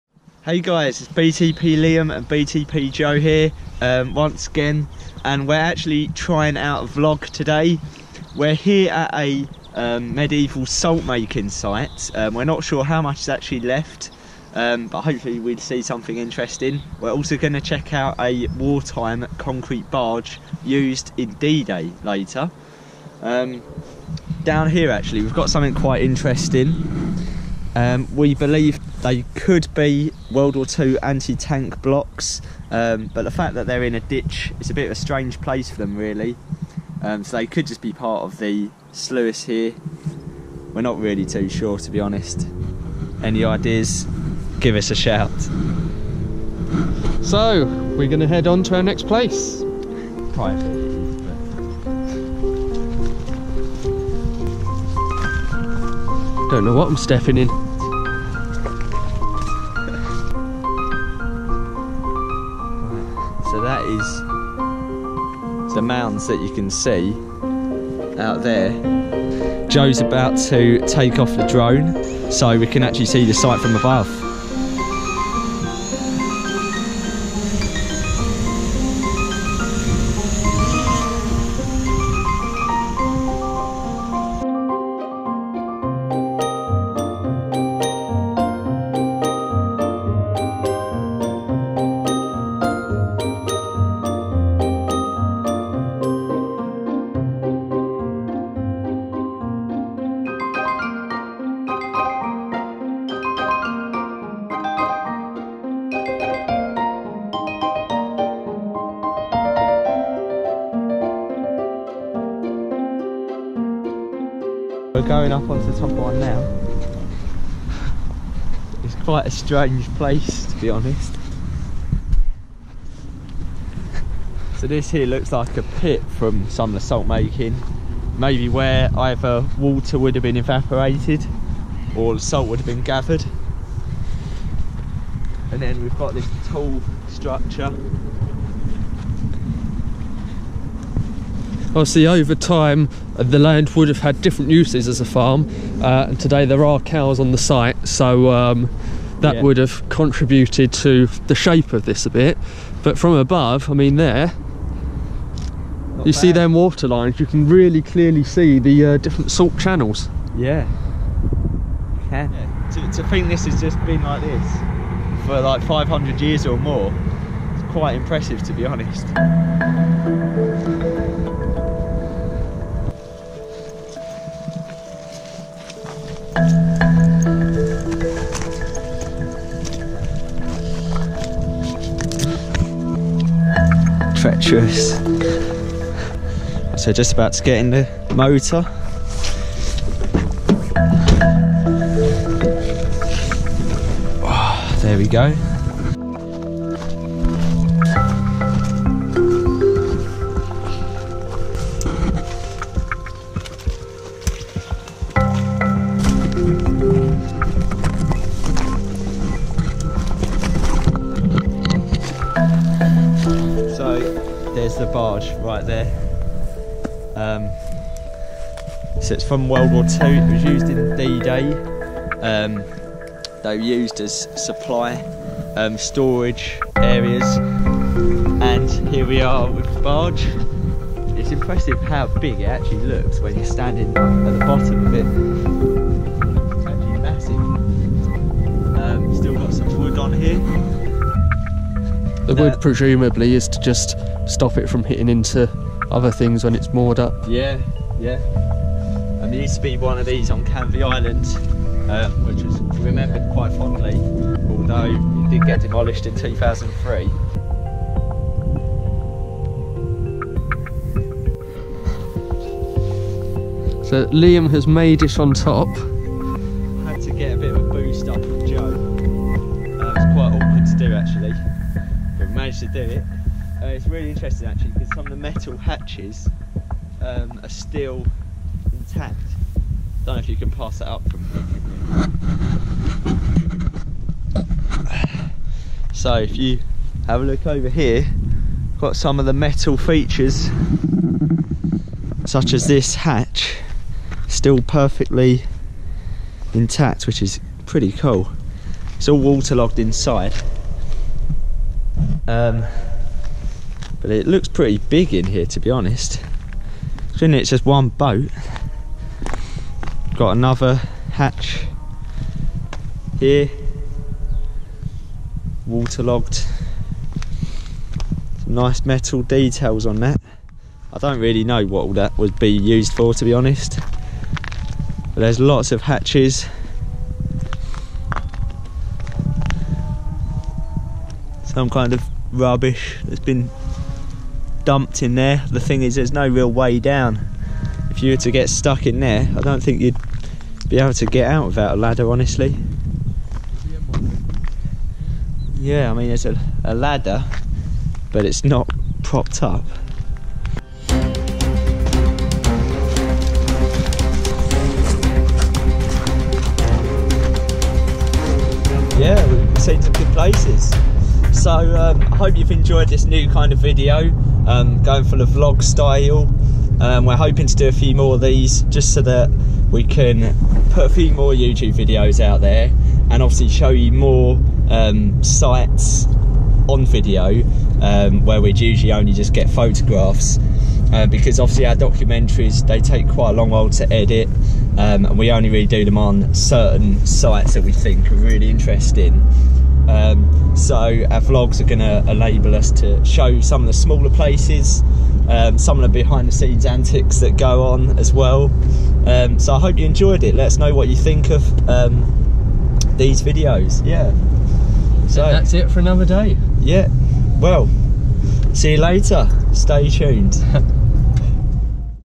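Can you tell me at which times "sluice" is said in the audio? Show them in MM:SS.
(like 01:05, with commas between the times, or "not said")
00:38.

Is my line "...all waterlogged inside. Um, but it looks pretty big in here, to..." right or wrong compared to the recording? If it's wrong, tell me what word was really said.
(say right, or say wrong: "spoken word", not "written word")
right.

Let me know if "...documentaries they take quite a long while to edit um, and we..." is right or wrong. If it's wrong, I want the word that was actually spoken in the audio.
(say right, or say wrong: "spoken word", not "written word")
right.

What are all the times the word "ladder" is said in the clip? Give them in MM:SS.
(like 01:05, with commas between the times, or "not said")
05:41, 05:46.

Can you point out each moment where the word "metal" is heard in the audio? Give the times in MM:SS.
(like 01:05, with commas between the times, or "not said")
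04:35, 04:49, 05:18.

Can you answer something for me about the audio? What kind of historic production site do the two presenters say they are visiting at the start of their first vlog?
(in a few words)
Medieval salt making site.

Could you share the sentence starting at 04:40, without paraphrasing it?
Don't know if you can pass that up from here.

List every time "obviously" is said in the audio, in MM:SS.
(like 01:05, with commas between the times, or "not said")
02:21, 06:13, 06:21.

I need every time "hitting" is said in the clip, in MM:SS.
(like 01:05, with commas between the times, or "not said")
04:04.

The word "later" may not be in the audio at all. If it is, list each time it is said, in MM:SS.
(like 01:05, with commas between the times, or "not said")
00:22, 06:48.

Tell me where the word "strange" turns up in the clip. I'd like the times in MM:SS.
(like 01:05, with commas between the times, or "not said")
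00:34, 01:59.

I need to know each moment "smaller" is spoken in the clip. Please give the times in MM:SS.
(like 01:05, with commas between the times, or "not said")
06:33.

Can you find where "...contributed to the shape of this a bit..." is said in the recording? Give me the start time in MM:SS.
02:29.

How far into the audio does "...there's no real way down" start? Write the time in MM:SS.
05:35.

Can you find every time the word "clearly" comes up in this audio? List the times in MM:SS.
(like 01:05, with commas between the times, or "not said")
02:37.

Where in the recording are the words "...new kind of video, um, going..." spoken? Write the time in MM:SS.
06:03.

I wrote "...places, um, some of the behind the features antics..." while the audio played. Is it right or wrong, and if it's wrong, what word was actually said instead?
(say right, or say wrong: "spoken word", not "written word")
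wrong: "scenes", not "features".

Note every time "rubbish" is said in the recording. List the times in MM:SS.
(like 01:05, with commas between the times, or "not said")
05:32.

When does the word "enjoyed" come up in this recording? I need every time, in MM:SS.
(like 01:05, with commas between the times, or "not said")
06:02, 06:39.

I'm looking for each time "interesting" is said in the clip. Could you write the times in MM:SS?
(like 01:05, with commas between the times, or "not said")
00:16, 00:26, 04:34, 06:28.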